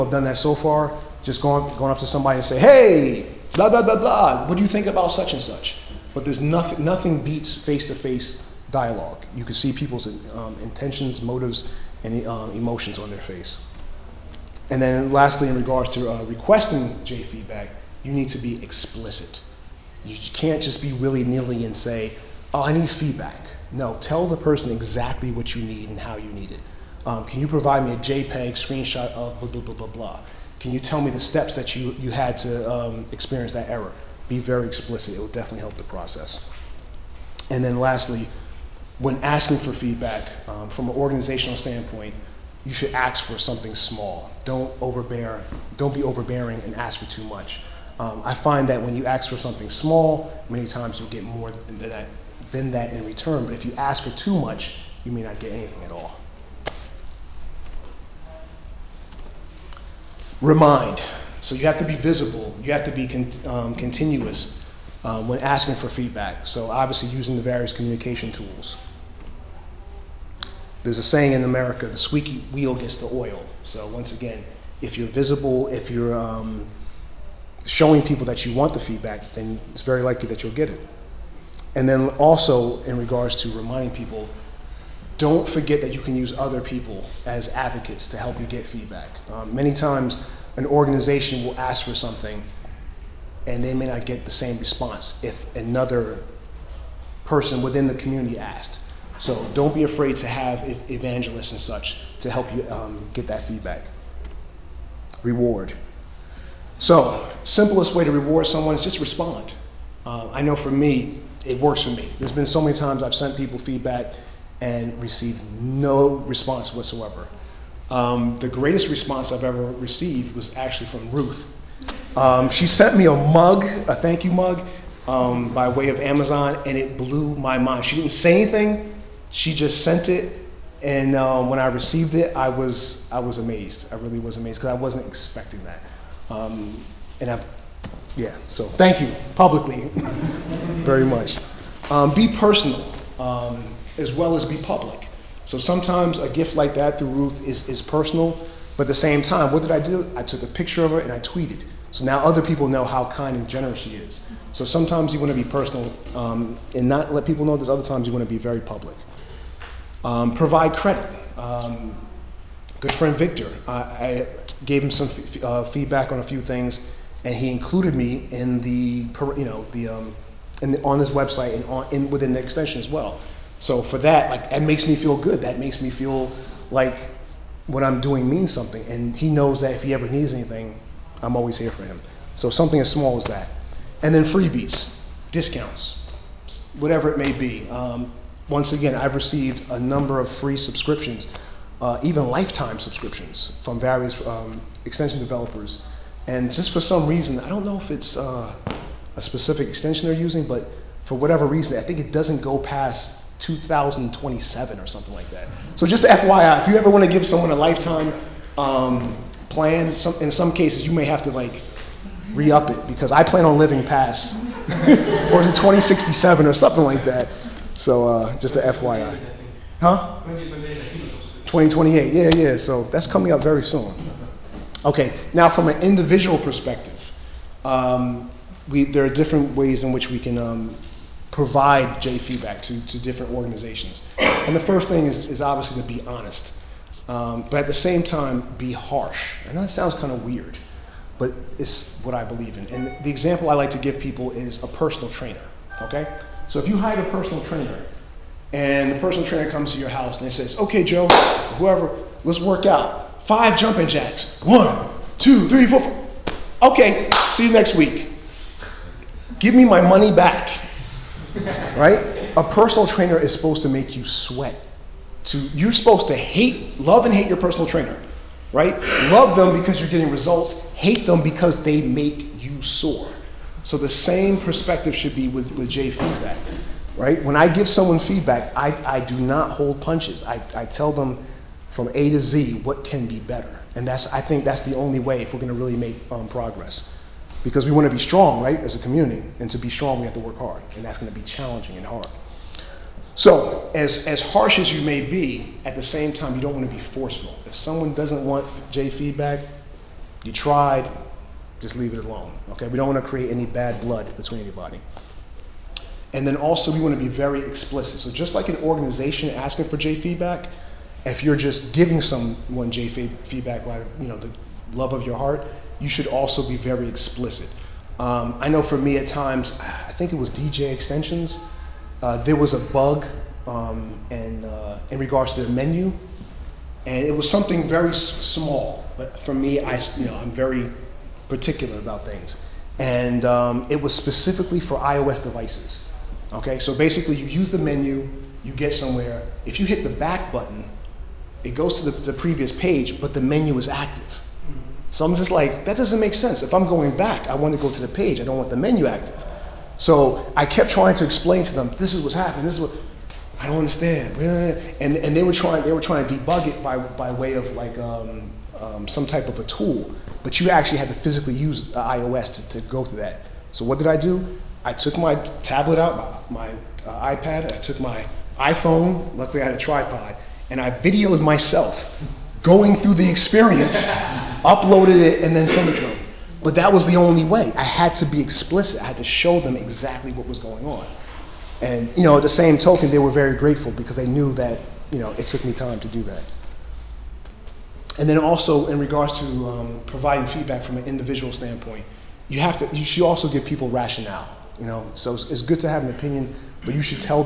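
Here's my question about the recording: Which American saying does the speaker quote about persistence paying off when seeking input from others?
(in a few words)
The squeaky wheel gets the oil.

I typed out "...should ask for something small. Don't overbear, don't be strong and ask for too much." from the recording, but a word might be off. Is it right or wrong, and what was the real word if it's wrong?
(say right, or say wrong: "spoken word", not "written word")
wrong: "overbearing", not "strong".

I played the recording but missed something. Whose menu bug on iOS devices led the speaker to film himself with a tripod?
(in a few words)
DJ Extensions.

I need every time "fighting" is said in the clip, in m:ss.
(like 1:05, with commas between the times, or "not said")
not said.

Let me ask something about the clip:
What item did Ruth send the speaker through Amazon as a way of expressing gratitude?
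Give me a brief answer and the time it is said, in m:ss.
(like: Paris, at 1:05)
A thank you mug, at 2:03.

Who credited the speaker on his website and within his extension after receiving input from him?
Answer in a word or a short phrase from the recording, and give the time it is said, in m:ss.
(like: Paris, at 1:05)
Victor, at 2:43.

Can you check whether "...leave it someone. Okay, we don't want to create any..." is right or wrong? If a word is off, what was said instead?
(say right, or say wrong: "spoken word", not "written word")
wrong: "alone", not "someone".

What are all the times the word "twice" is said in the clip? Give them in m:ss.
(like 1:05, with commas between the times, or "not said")
not said.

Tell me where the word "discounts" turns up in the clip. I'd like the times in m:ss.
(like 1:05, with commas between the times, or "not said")
3:05.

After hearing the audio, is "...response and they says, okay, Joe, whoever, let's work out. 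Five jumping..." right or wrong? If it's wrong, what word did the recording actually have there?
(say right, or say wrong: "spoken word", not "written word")
wrong: "house", not "response".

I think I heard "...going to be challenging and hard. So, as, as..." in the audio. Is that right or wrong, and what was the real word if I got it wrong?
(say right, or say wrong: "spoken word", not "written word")
right.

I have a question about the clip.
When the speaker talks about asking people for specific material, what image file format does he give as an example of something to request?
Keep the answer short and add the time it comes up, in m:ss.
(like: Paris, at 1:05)
JPEG, at 0:27.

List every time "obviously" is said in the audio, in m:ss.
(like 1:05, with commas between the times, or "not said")
1:06, 3:55.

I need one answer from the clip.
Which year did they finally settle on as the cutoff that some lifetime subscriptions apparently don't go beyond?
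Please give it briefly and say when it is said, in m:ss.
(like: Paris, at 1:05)
2028, at 3:40.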